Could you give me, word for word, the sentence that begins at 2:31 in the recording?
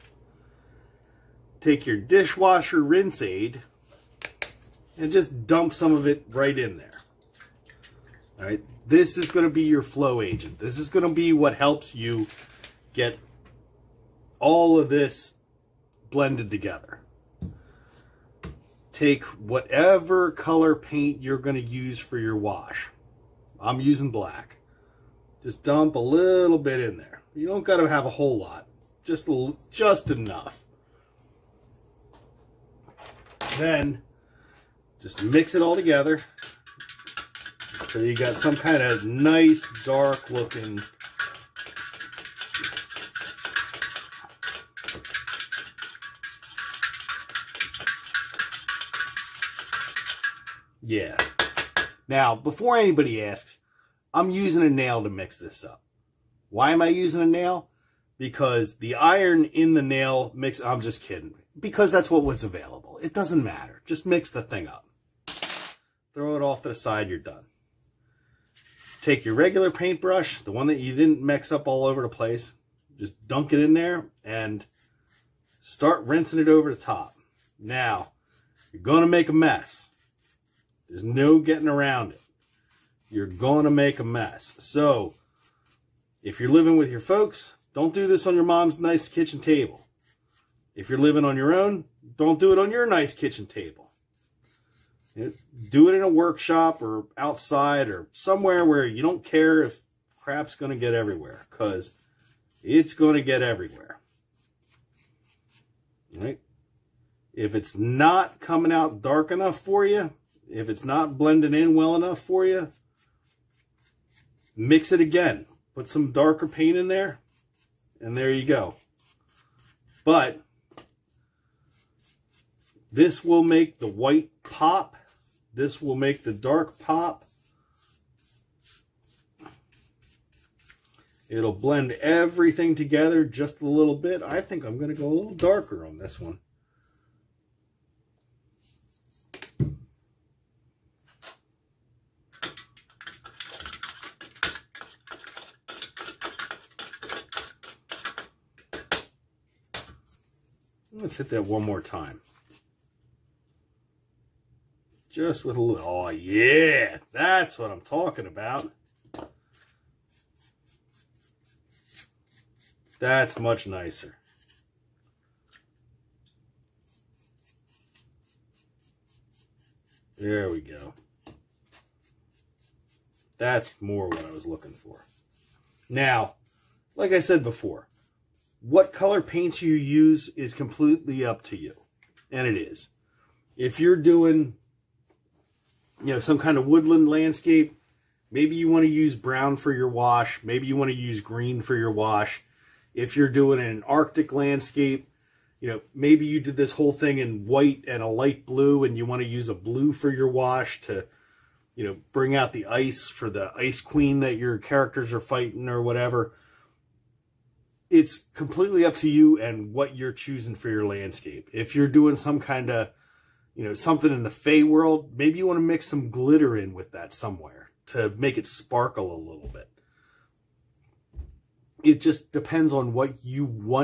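Let's hit that one more time.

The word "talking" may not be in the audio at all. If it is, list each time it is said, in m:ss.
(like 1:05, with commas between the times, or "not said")
2:37.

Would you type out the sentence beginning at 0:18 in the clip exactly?
Take whatever color paint you're going to use for your wash.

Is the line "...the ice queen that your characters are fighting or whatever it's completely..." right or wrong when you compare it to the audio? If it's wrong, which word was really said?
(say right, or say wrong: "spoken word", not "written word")
right.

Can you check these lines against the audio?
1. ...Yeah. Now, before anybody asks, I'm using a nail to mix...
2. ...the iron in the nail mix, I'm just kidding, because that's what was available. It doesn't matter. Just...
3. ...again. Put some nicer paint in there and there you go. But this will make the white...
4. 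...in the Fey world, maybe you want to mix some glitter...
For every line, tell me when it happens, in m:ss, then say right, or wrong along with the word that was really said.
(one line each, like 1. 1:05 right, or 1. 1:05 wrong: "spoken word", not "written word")
1. 0:50 right
2. 0:58 right
3. 1:55 wrong: "darker", not "nicer"
4. 3:34 right.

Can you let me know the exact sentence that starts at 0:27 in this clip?
You don't got to have a whole lot.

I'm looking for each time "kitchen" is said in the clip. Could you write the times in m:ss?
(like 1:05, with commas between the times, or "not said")
1:29, 1:33.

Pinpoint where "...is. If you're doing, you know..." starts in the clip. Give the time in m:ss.
3:02.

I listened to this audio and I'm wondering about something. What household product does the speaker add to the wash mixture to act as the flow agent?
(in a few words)
dishwasher rinse aid.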